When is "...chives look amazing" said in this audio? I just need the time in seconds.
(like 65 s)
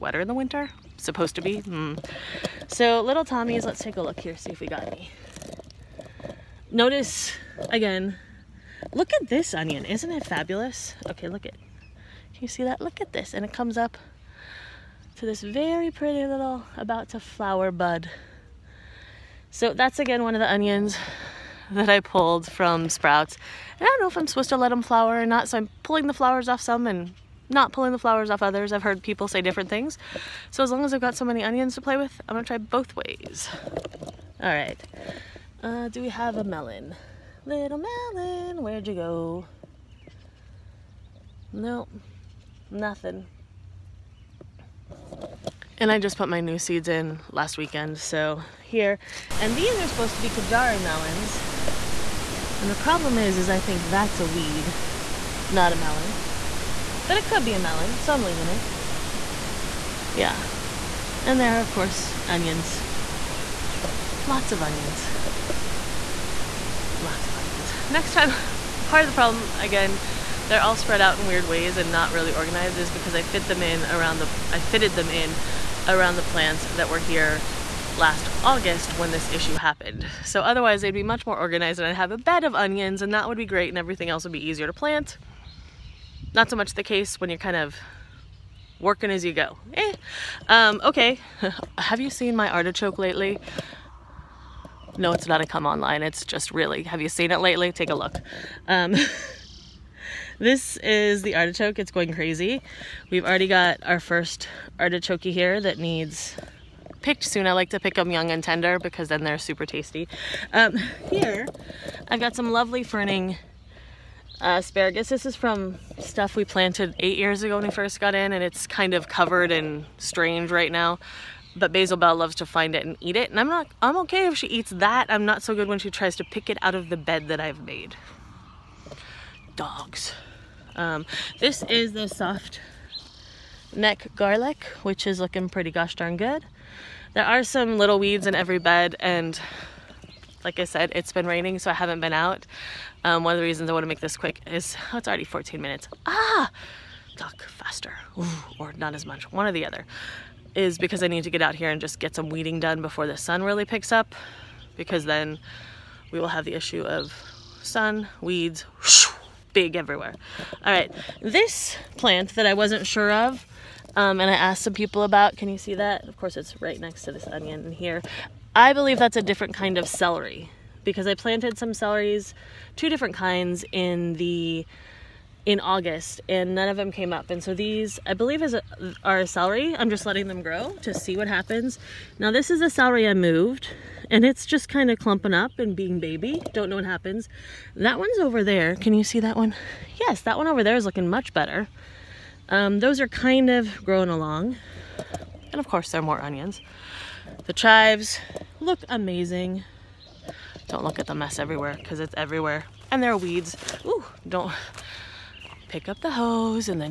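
197 s.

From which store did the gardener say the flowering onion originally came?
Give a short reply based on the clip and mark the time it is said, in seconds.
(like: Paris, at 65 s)
Sprouts, at 22 s.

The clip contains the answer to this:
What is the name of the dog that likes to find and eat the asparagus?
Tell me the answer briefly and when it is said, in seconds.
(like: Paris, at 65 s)
Basil Bell, at 121 s.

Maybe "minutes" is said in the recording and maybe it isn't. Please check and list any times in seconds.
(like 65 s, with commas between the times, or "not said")
145 s.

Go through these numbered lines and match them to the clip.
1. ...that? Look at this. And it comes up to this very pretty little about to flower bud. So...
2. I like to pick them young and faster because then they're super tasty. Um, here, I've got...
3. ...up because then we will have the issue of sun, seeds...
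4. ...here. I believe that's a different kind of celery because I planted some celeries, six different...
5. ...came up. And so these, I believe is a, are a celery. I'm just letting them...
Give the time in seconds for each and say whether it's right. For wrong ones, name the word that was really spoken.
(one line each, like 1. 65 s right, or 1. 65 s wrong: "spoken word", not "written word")
1. 12 s right
2. 107 s wrong: "tender", not "faster"
3. 153 s wrong: "weeds", not "seeds"
4. 167 s wrong: "two", not "six"
5. 176 s right.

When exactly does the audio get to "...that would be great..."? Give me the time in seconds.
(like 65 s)
83 s.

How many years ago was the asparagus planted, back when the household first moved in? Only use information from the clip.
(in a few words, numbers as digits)
8.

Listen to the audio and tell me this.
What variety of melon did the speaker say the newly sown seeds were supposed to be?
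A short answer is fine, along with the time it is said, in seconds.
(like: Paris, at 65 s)
Kajari, at 50 s.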